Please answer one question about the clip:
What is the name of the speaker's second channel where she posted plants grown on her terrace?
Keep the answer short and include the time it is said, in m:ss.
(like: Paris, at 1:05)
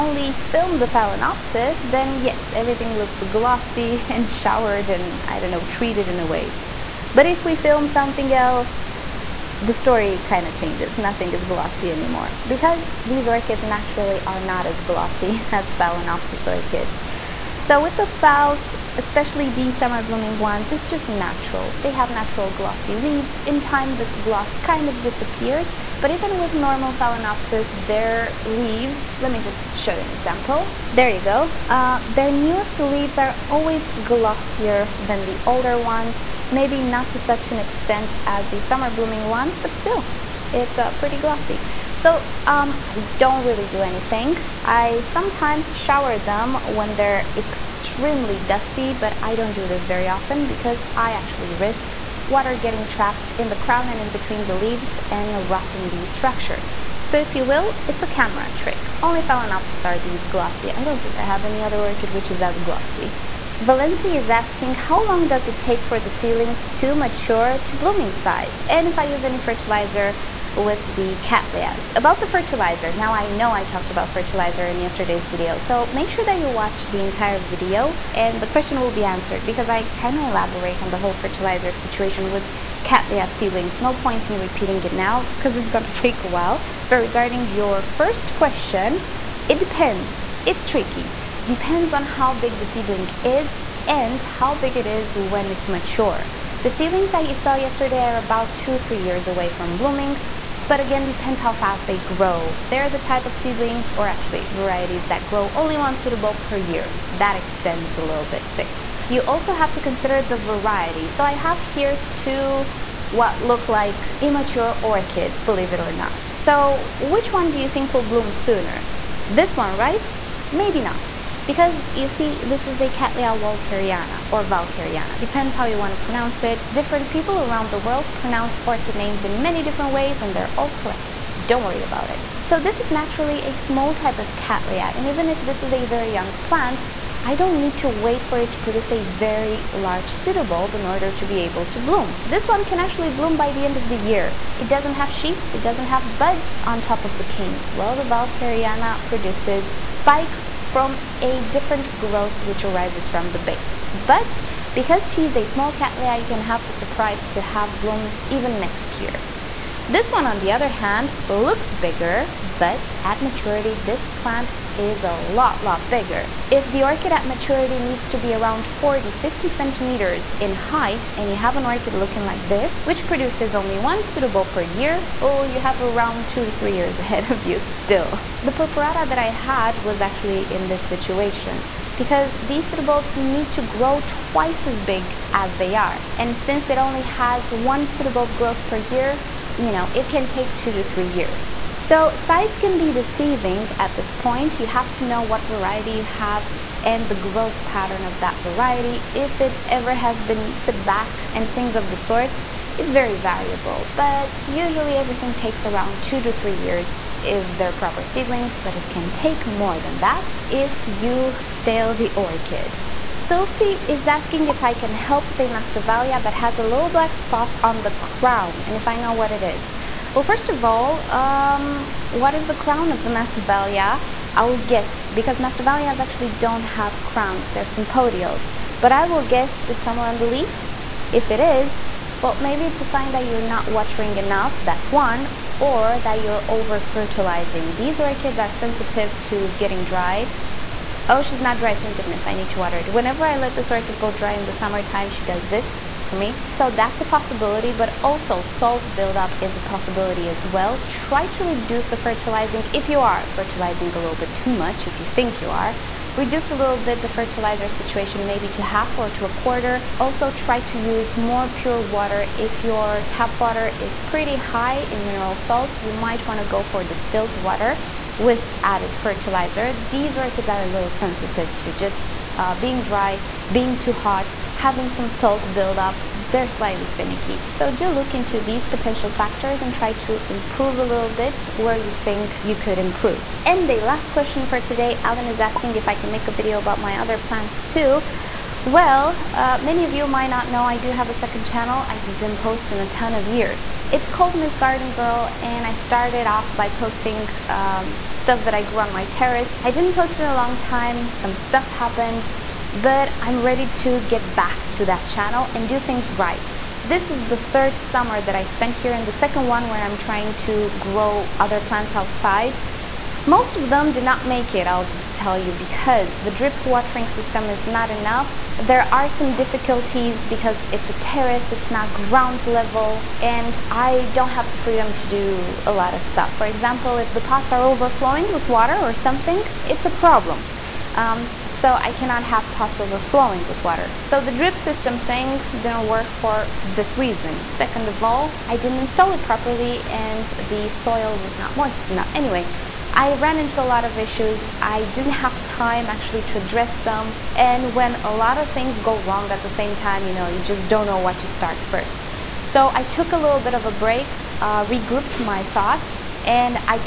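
Miss Garden Girl, at 4:54.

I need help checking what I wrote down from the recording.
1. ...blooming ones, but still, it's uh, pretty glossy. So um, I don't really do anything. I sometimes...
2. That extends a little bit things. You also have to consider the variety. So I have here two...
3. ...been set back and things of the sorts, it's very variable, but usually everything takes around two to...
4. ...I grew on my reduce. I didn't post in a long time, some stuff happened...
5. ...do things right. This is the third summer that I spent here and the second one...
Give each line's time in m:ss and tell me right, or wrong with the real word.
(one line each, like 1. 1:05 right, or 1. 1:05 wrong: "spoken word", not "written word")
1. 0:38 right
2. 1:47 right
3. 3:20 right
4. 4:58 wrong: "terrace", not "reduce"
5. 5:05 right.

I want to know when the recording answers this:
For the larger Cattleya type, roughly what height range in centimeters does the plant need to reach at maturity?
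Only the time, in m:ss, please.
2:48.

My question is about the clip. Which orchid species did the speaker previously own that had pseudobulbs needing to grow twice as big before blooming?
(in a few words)
purpurata.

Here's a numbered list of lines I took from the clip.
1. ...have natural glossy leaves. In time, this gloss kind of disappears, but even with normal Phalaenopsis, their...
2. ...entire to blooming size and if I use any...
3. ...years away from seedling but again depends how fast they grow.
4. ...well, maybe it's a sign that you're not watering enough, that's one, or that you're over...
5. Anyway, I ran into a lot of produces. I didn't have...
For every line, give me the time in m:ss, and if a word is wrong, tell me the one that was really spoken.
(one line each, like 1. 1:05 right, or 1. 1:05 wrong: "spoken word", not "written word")
1. 0:21 right
2. 1:06 wrong: "mature", not "entire"
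3. 1:38 wrong: "blooming", not "seedling"
4. 3:52 right
5. 5:42 wrong: "issues", not "produces".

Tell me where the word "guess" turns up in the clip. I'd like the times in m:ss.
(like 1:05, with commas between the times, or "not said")
3:44, 3:49.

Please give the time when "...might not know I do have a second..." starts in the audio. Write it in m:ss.
4:50.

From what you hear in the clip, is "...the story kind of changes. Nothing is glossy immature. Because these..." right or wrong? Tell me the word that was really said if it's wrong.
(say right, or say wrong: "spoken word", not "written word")
wrong: "anymore", not "immature".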